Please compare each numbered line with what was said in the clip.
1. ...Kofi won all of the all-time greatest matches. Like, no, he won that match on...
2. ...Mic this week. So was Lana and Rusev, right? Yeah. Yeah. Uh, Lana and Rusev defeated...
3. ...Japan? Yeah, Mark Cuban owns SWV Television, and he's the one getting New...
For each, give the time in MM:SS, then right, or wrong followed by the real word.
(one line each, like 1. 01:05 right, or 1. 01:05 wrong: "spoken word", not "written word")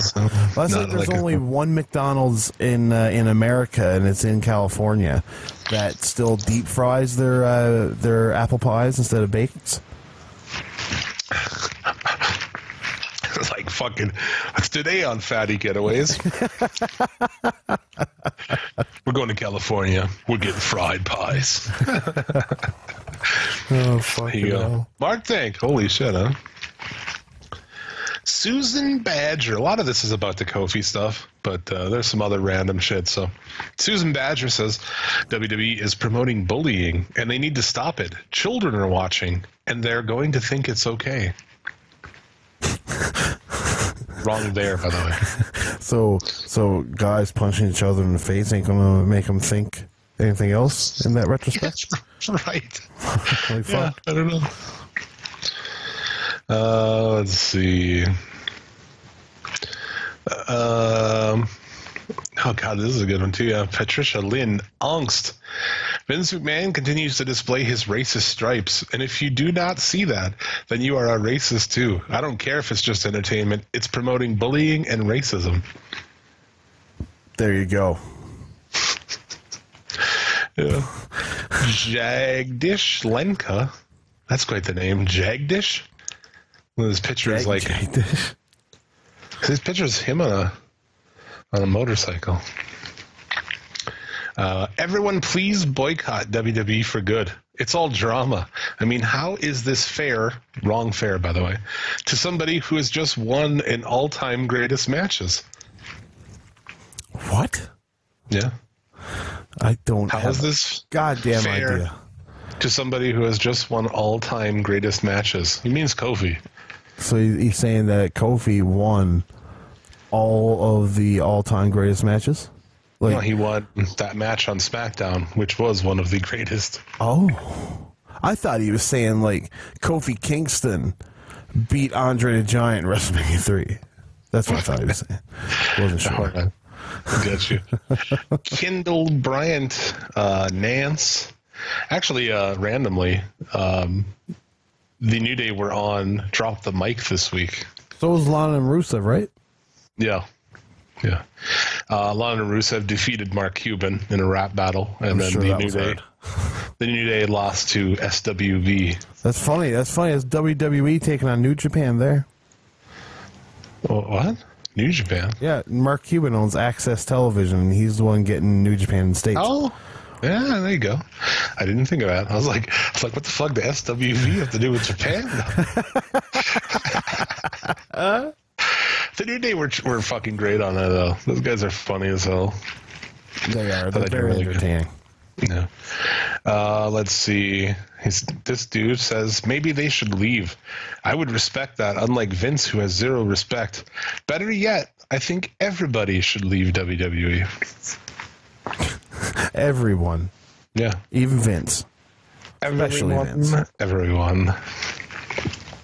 1. 01:58 right
2. 02:26 right
3. 02:44 wrong: "AXS", not "SWV".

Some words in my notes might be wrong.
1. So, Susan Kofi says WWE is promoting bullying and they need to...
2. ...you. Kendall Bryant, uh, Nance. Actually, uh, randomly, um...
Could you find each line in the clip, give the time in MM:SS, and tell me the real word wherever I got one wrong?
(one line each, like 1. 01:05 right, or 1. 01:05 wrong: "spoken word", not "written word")
1. 00:33 wrong: "Badger", not "Kofi"
2. 02:17 right.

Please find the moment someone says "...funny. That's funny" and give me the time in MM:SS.
02:39.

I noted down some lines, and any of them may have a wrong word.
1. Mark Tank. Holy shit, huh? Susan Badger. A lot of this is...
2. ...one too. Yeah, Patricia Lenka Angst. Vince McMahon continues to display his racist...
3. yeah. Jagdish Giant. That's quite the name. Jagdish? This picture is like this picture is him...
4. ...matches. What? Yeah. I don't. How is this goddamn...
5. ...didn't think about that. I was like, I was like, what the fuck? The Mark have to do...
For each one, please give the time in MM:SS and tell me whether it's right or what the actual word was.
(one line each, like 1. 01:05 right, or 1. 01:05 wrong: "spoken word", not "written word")
1. 00:24 right
2. 01:03 wrong: "Lynn", not "Lenka"
3. 01:20 wrong: "Lenka", not "Giant"
4. 01:44 right
5. 02:51 wrong: "SWV", not "Mark".